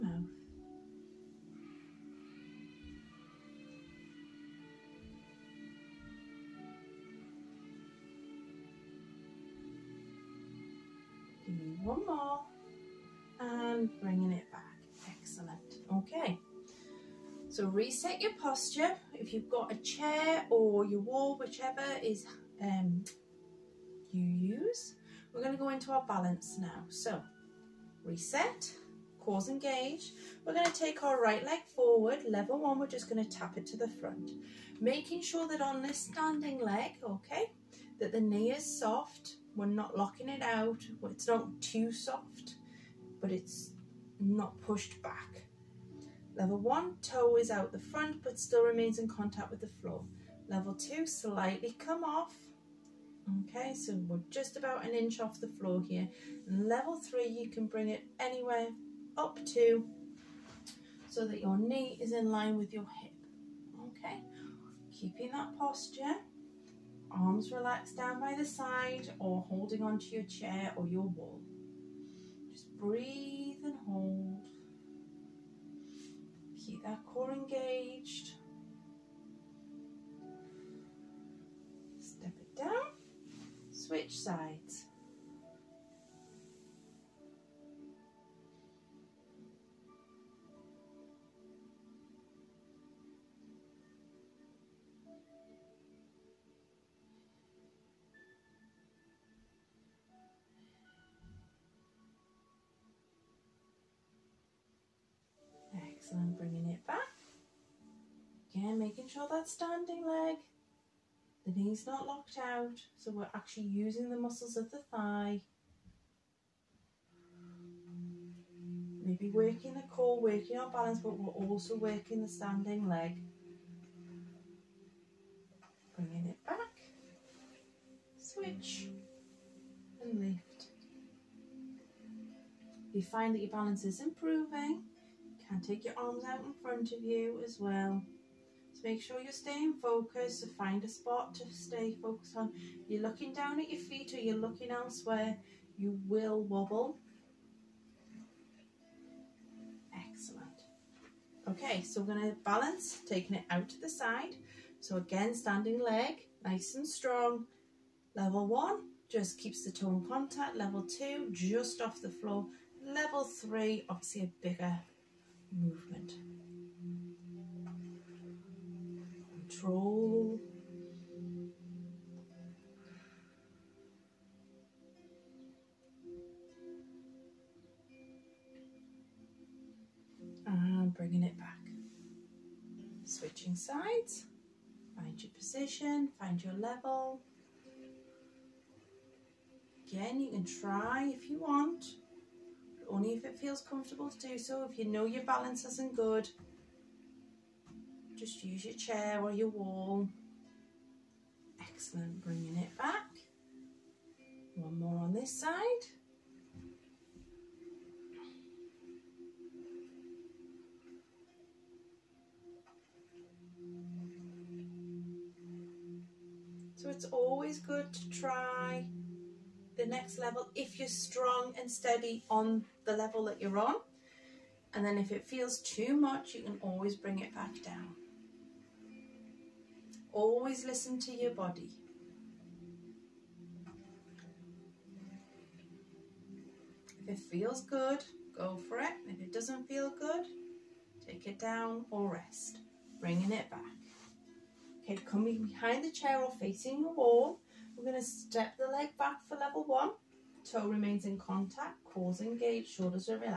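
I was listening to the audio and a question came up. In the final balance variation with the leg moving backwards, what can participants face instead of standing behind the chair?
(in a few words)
the wall.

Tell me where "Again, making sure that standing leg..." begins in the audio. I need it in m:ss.
1:48.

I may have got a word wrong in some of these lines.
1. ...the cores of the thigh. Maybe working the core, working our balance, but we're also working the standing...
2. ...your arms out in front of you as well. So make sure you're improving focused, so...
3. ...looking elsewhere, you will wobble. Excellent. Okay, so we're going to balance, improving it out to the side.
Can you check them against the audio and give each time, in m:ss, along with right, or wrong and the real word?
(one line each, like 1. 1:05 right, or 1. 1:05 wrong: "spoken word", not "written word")
1. 1:54 wrong: "muscles", not "cores"
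2. 2:15 wrong: "staying", not "improving"
3. 2:24 wrong: "taking", not "improving".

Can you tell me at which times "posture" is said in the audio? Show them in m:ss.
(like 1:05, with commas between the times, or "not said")
0:18, 1:05.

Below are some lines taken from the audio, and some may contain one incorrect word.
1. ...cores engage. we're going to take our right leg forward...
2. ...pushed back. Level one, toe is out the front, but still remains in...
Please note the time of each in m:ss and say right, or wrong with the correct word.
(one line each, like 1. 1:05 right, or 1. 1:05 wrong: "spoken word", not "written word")
1. 0:29 right
2. 0:44 right.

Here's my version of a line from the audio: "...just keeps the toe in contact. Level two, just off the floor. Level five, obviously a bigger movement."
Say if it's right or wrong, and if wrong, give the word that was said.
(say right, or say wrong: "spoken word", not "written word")
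wrong: "three", not "five".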